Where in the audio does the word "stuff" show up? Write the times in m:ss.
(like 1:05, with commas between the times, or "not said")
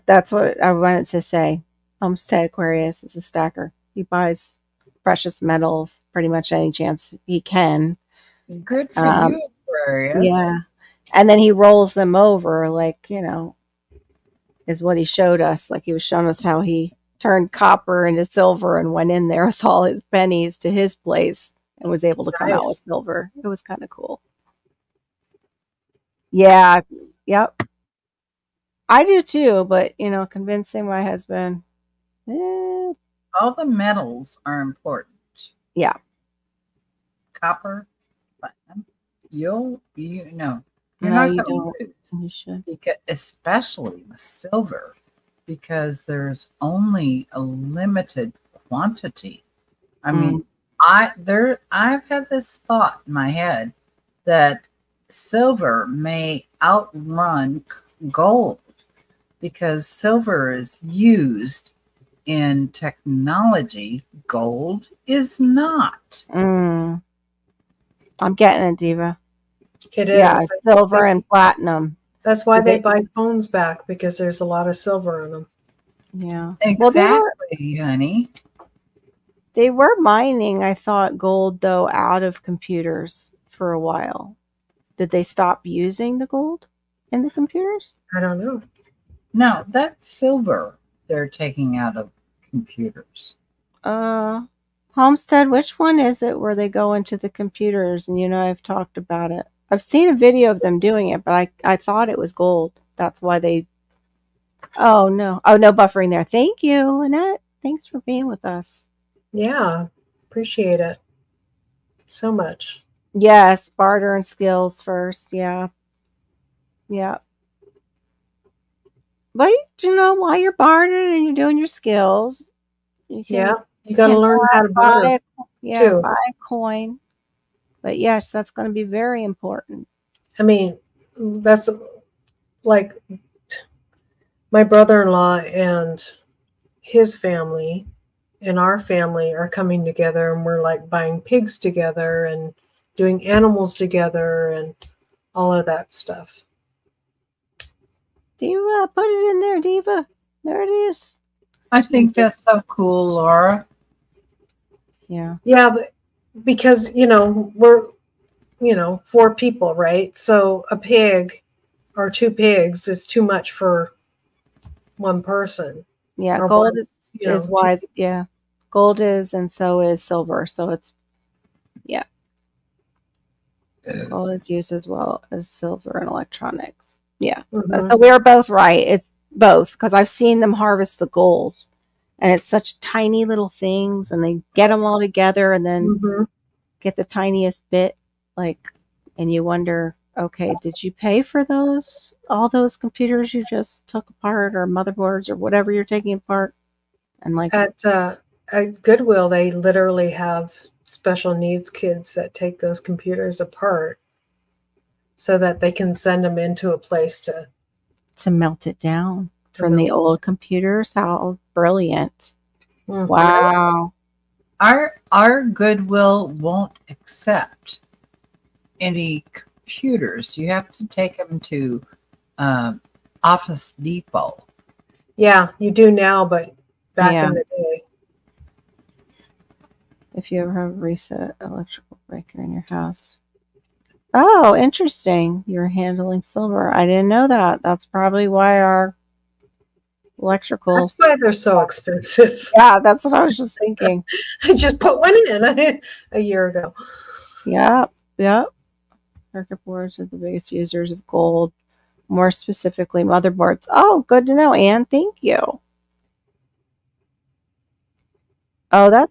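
2:25.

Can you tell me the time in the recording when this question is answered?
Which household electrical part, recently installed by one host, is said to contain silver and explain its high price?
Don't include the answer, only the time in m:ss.
3:51.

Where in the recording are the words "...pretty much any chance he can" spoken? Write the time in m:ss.
0:06.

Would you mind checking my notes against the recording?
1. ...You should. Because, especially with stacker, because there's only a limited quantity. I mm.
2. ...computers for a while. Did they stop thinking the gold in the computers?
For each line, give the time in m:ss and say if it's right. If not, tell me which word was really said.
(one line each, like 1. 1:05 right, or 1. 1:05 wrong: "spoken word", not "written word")
1. 0:42 wrong: "silver", not "stacker"
2. 1:22 wrong: "using", not "thinking".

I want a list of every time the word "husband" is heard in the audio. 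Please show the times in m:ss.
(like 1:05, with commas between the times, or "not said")
0:31.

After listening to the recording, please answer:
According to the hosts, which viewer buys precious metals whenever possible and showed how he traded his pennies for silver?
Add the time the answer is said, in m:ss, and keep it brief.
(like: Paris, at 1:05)
Homestead Aquarius, at 0:02.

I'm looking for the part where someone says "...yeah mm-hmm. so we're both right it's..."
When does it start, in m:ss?
2:57.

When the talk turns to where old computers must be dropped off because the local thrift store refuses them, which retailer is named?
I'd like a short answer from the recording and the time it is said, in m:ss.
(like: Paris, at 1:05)
Office Depot, at 3:43.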